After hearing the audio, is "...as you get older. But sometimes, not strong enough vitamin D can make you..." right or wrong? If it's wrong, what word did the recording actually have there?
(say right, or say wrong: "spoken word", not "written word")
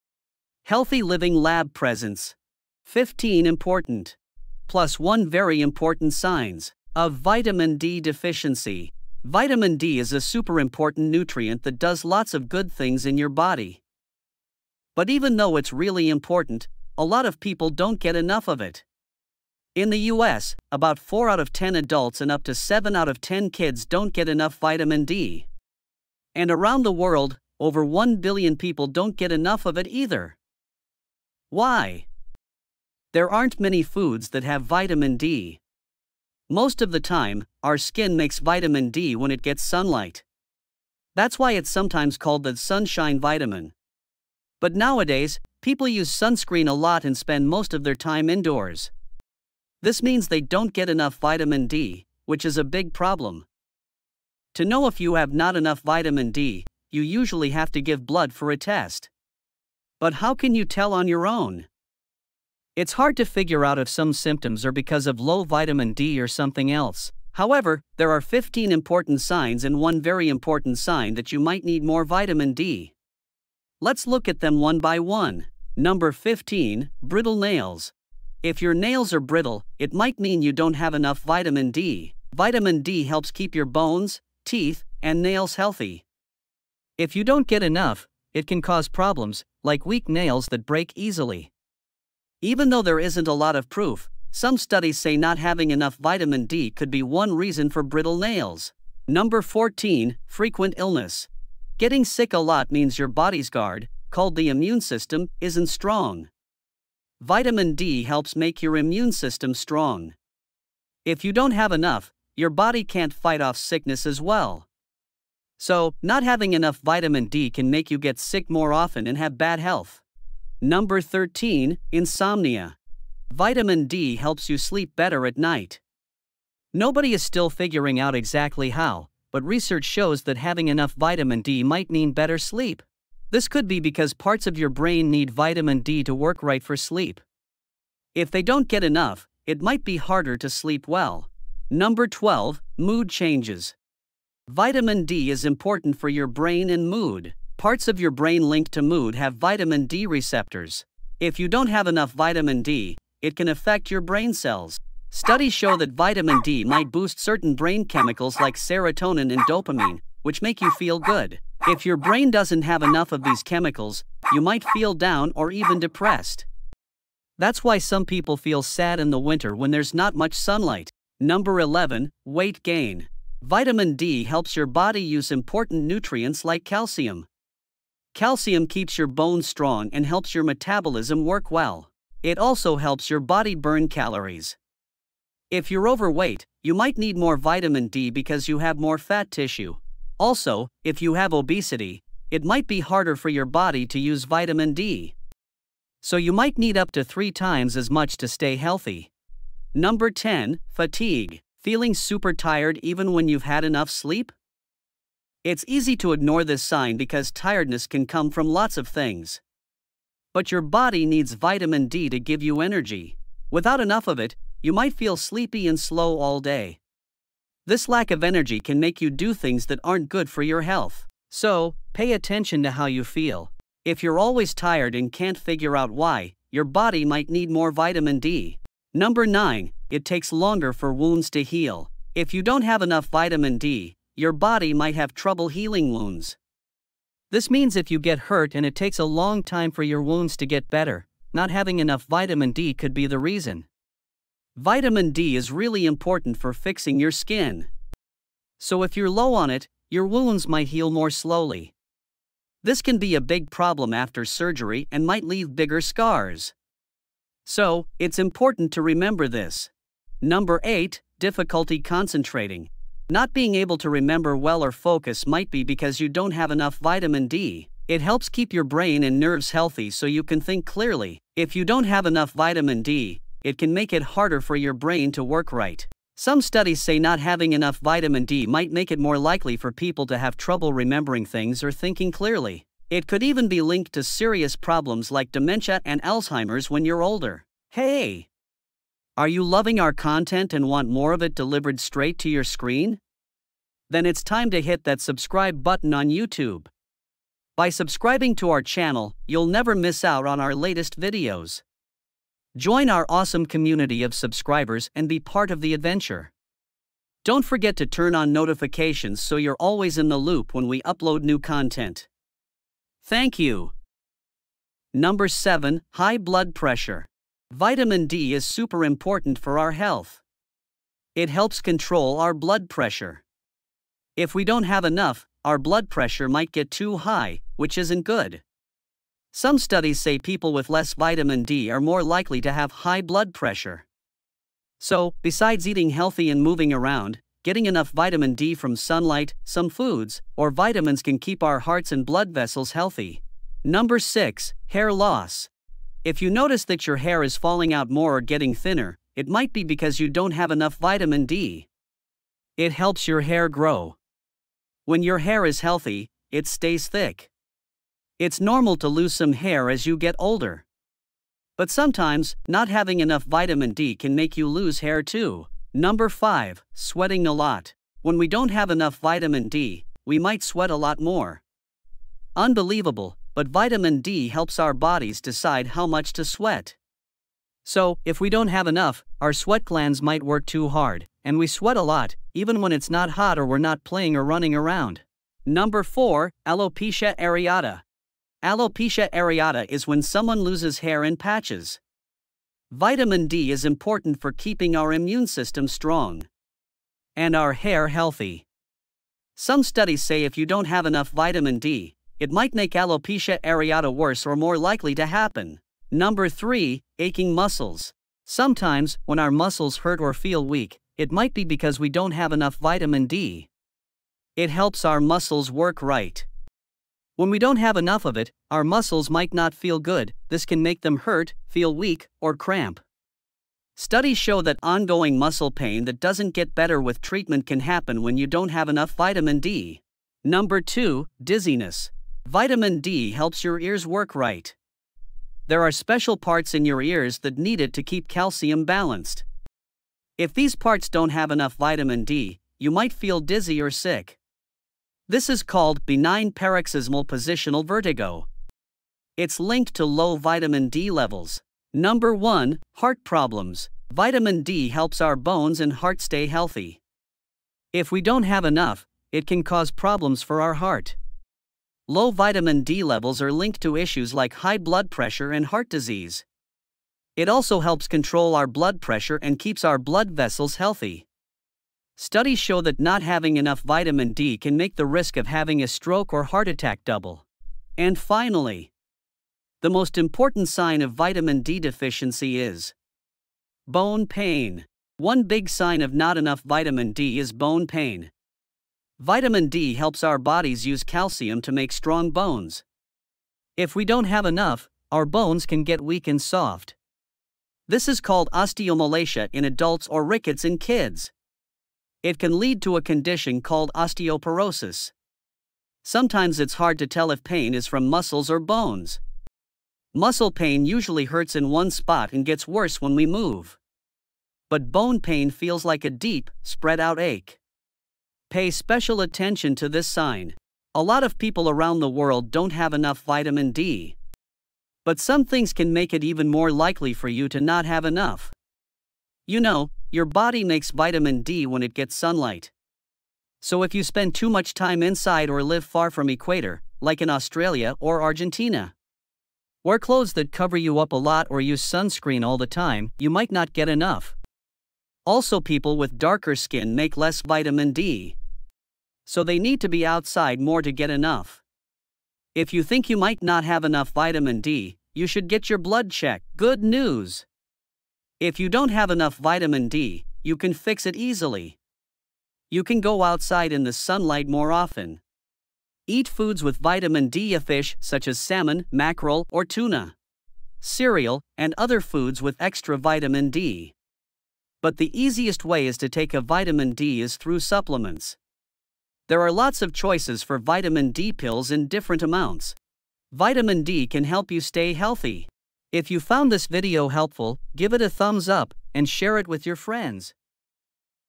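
wrong: "having", not "strong".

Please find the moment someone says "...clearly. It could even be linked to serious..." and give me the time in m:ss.
4:42.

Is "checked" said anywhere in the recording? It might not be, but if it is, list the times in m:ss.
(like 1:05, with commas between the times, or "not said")
9:15.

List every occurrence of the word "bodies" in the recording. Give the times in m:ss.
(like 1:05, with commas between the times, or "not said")
6:14, 8:10.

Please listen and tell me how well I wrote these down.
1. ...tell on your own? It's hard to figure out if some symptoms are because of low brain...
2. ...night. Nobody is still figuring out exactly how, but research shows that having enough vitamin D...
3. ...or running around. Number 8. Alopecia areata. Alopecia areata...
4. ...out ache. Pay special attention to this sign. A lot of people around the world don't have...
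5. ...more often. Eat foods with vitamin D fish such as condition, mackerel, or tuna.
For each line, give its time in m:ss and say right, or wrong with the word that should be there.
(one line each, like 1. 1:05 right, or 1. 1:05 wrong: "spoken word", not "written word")
1. 1:00 wrong: "vitamin", not "brain"
2. 2:05 right
3. 6:24 wrong: "4", not "8"
4. 8:36 right
5. 9:24 wrong: "salmon", not "condition".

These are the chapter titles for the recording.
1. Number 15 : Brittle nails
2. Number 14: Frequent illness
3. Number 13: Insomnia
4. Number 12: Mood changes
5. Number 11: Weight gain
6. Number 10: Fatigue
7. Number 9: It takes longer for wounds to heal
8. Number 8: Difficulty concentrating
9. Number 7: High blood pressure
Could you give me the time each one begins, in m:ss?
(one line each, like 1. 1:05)
1. 1:16
2. 1:41
3. 2:01
4. 2:22
5. 2:52
6. 3:20
7. 3:49
8. 4:21
9. 5:16.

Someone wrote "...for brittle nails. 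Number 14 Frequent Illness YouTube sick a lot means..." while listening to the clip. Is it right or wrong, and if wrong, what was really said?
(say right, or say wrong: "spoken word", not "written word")
wrong: "Getting", not "YouTube".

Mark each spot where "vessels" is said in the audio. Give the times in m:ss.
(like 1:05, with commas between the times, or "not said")
5:42, 7:50.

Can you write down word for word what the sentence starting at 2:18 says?
If they don't get enough, it might be harder to sleep well.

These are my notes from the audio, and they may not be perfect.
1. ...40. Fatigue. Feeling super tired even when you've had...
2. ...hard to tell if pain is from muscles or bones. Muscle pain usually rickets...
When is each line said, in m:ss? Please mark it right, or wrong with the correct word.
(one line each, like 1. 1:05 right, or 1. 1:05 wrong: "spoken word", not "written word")
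1. 3:20 wrong: "10", not "40"
2. 8:26 wrong: "hurts", not "rickets".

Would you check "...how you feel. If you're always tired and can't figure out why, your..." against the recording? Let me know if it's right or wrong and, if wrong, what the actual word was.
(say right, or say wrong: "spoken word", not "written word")
right.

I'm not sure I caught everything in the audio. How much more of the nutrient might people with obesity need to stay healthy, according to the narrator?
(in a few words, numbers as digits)
up to three times.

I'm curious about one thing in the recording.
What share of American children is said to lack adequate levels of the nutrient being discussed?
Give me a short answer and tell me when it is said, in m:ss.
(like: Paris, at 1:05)
up to 7 out of 10, at 0:22.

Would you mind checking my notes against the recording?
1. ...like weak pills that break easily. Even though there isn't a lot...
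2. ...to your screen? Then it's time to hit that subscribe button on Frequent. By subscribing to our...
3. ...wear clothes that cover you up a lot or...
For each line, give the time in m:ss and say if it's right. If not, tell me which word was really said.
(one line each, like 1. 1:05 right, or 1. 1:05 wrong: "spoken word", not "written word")
1. 1:29 wrong: "nails", not "pills"
2. 4:52 wrong: "YouTube", not "Frequent"
3. 8:59 right.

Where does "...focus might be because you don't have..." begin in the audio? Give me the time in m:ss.
4:24.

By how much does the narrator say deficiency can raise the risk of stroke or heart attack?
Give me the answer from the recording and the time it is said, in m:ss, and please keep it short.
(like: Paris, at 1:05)
double, at 7:56.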